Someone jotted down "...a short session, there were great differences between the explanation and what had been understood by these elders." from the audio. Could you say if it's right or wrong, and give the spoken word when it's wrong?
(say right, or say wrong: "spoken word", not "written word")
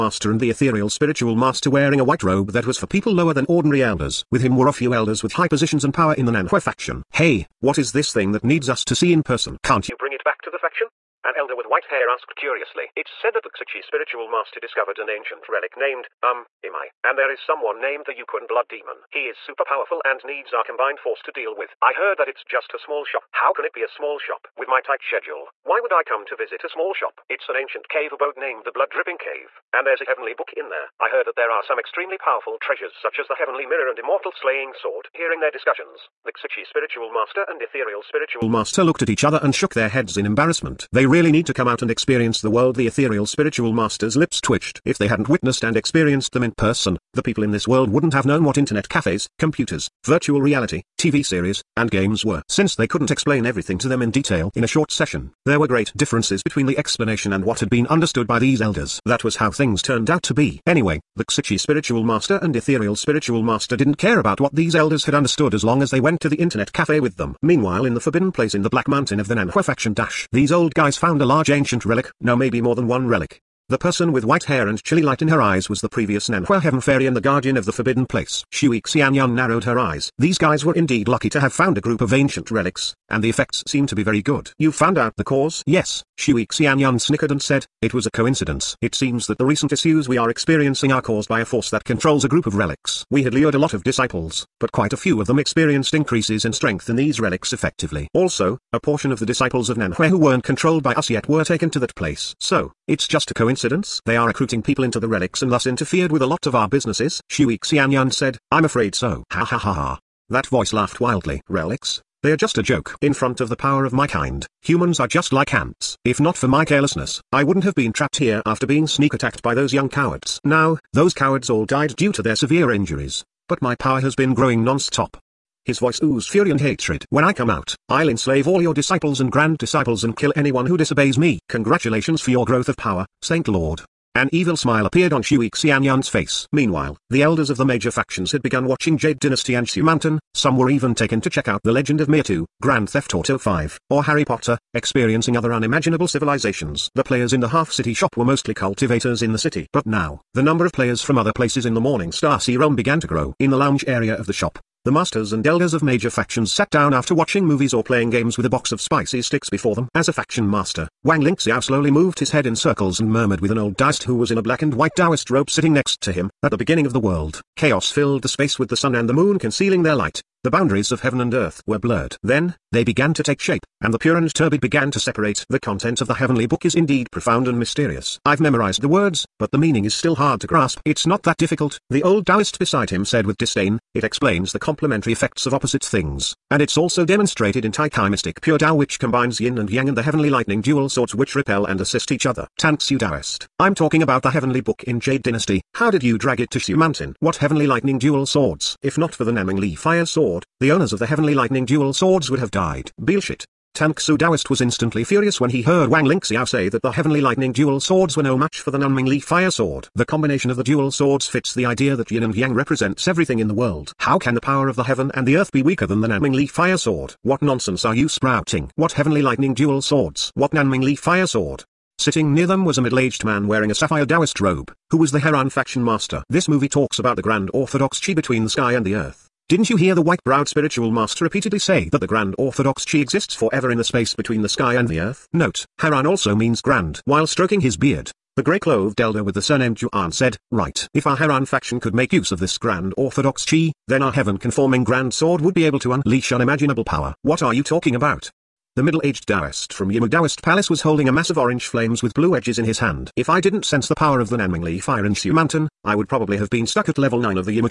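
right.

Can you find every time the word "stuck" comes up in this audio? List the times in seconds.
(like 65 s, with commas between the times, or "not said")
256 s.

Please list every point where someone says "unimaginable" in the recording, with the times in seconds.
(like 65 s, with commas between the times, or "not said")
145 s, 246 s.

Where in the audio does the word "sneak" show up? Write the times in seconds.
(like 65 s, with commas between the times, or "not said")
118 s.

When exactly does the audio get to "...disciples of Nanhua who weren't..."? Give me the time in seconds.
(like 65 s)
99 s.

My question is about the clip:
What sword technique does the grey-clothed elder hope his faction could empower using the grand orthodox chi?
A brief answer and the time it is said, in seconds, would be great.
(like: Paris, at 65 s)
heaven-conforming grand sword, at 244 s.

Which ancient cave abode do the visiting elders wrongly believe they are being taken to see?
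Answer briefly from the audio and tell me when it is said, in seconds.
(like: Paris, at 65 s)
Blood Dripping Cave, at 28 s.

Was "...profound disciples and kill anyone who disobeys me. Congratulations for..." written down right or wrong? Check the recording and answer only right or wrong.
wrong.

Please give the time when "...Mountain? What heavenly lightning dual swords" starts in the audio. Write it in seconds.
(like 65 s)
196 s.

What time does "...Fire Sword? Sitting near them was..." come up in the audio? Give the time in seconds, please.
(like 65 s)
220 s.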